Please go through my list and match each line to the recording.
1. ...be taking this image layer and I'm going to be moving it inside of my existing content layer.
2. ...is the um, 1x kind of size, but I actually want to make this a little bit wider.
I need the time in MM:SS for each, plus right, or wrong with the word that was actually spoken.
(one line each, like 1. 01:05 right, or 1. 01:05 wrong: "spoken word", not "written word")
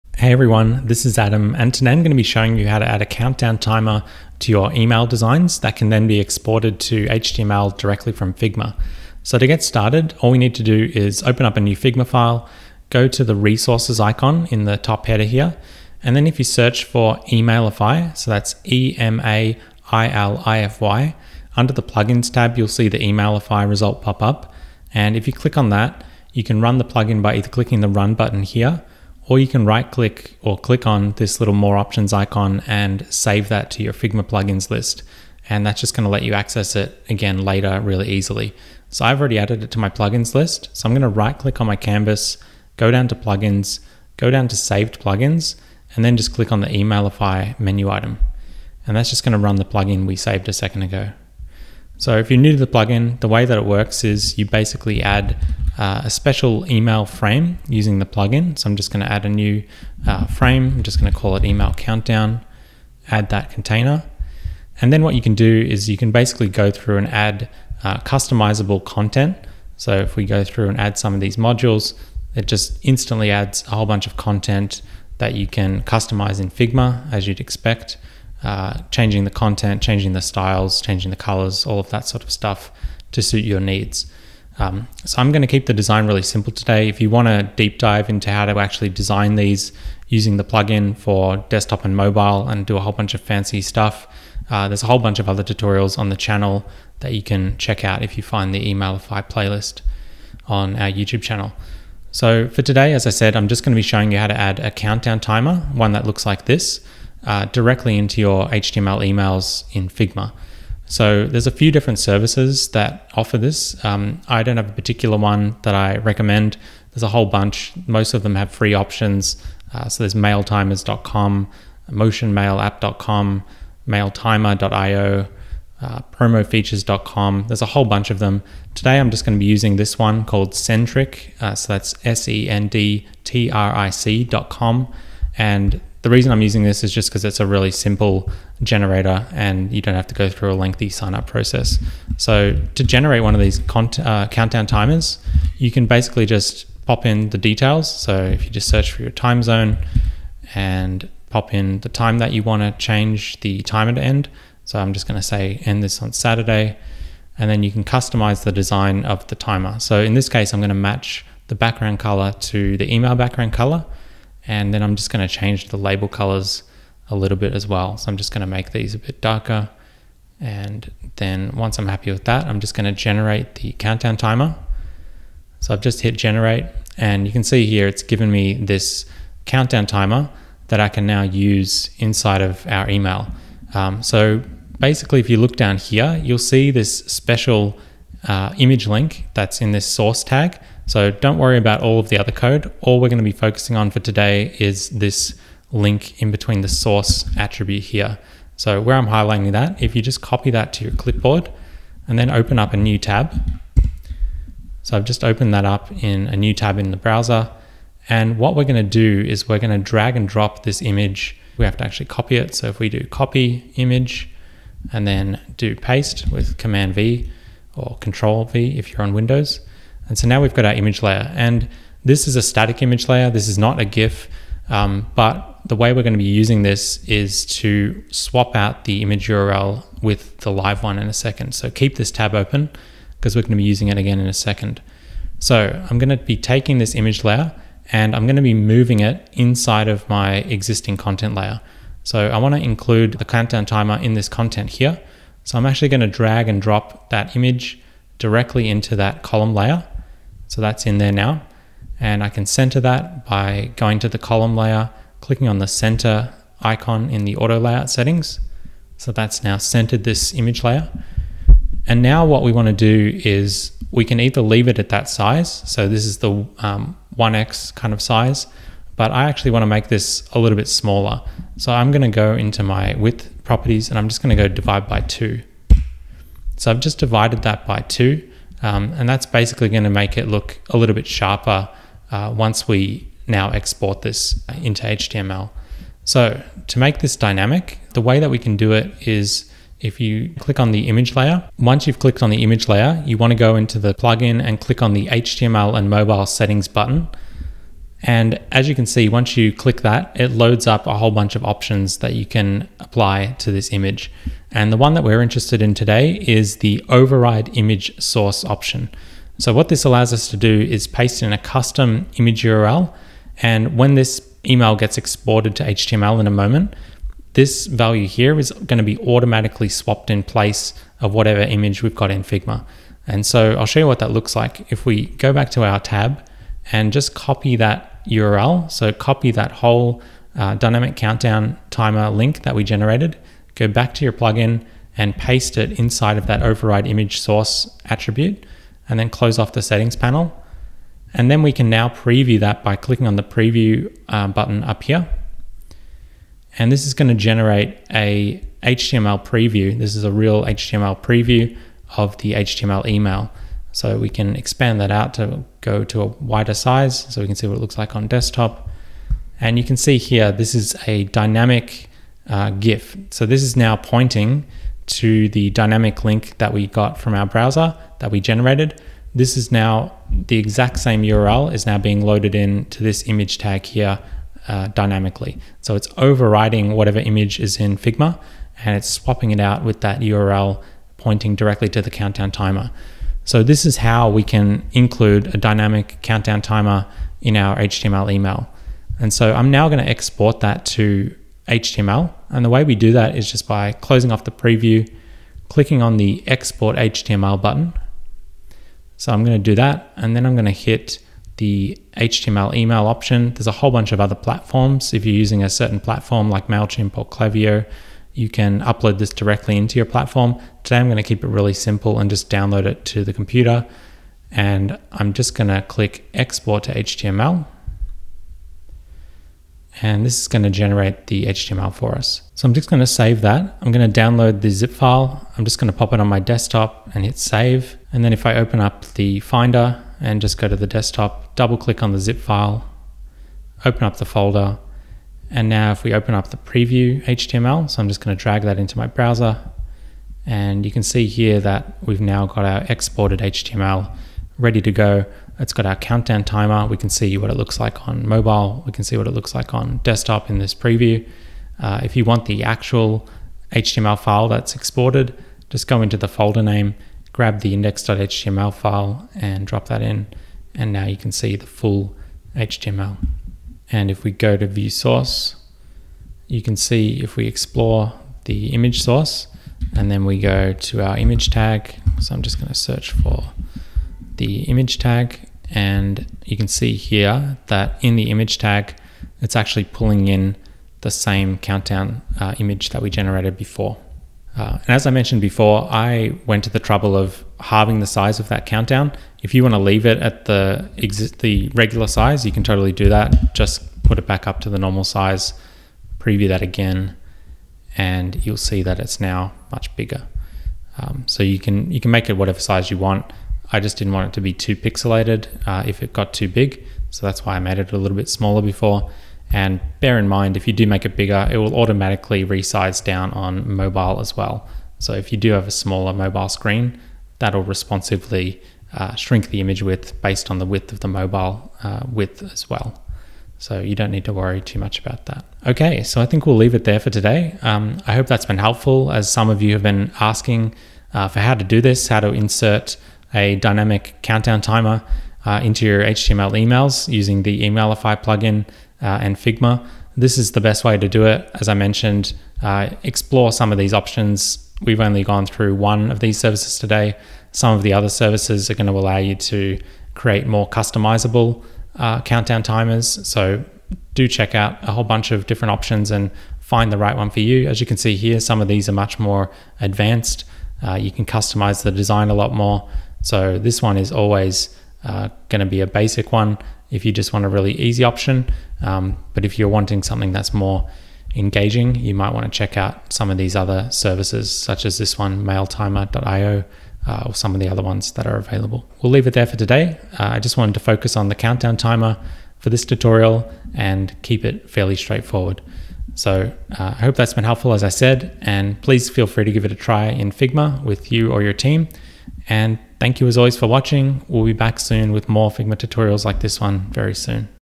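1. 03:56 right
2. 04:26 wrong: "smaller", not "wider".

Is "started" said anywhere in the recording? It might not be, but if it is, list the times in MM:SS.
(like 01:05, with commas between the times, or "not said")
00:09.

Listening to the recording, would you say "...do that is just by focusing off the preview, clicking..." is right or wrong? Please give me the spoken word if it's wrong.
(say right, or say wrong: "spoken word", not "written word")
wrong: "closing", not "focusing".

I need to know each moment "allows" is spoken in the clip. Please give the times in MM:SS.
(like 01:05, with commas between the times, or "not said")
05:09, 09:08.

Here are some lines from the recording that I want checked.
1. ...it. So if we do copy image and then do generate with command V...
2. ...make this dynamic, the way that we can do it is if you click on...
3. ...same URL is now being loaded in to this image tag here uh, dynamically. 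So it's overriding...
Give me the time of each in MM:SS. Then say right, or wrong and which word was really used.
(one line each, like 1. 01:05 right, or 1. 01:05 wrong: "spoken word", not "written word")
1. 03:32 wrong: "paste", not "generate"
2. 04:46 right
3. 06:10 right.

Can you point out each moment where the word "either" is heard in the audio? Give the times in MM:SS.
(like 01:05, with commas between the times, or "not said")
00:27, 04:24.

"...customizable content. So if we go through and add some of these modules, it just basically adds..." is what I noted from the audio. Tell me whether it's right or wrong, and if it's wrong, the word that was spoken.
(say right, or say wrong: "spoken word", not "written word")
wrong: "instantly", not "basically".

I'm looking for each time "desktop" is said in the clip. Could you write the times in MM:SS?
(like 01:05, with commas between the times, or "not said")
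01:31, 05:58, 07:06, 07:10, 07:29.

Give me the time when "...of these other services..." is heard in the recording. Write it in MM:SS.
09:33.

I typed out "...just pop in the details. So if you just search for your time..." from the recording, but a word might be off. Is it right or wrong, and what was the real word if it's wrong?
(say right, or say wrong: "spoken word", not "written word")
right.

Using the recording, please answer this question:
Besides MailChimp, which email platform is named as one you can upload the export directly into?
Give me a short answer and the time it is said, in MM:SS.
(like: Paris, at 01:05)
Klaviyo, at 06:47.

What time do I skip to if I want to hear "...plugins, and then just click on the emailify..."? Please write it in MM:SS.
00:44.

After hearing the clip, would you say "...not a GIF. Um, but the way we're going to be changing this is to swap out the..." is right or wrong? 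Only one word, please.
wrong.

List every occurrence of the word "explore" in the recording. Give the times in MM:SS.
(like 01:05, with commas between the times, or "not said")
07:47, 09:02.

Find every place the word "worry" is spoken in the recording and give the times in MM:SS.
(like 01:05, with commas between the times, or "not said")
03:11, 08:44.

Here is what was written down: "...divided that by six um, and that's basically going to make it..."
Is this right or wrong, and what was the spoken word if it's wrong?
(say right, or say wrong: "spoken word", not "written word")
wrong: "two", not "six".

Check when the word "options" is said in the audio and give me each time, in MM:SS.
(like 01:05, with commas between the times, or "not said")
00:31, 01:58, 05:01, 05:08, 06:42, 09:03, 09:15, 09:27.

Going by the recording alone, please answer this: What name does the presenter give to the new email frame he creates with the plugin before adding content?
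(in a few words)
email countdown.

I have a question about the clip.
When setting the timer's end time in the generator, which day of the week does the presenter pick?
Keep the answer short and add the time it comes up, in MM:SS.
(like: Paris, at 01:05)
Saturday, at 02:36.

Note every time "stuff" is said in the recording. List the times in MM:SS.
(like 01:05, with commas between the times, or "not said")
01:22, 01:33.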